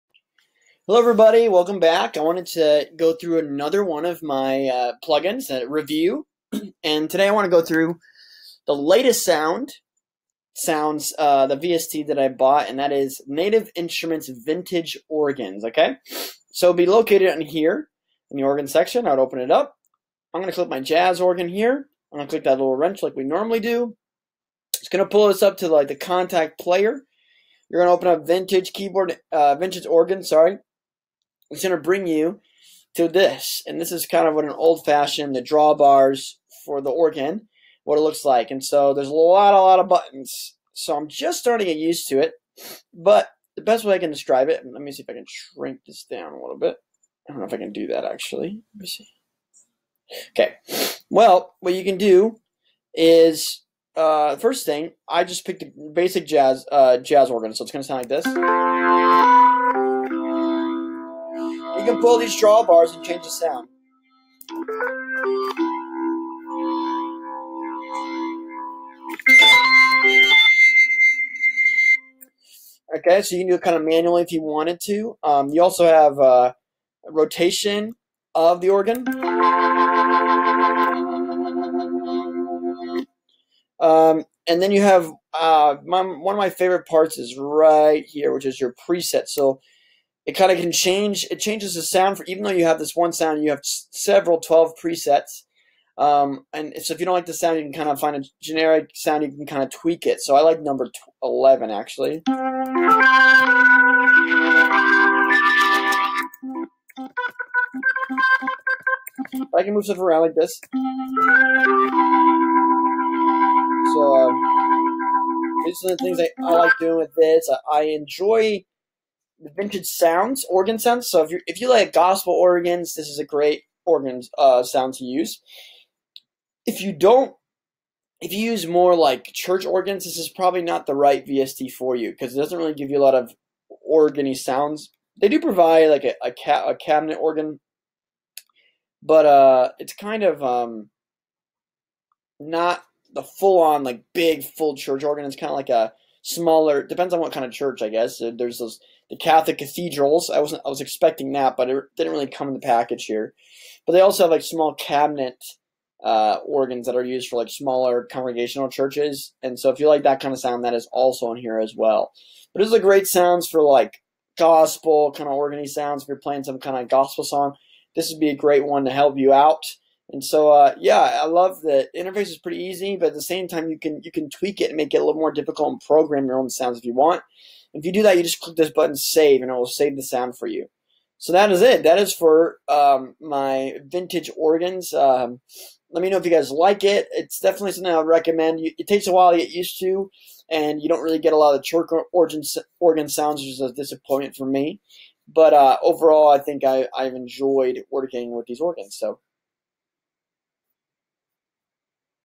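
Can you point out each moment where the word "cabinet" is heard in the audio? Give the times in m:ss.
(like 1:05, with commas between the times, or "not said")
2:16, 2:34.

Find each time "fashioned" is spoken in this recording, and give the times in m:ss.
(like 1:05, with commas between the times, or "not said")
0:34.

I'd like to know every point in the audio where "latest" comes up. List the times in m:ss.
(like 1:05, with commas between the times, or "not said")
0:08.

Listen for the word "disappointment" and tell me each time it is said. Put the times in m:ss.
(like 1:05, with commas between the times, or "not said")
3:13.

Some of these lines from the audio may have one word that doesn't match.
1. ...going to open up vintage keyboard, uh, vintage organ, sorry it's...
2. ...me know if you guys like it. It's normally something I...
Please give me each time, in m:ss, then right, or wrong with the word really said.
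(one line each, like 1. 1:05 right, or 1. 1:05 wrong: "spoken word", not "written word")
1. 0:27 right
2. 3:06 wrong: "definitely", not "normally".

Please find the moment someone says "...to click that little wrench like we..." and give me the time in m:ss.
0:22.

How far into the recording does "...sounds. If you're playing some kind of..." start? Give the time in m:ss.
2:45.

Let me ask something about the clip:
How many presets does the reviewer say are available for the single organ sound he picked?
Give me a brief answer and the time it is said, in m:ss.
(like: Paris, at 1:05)
12, at 1:34.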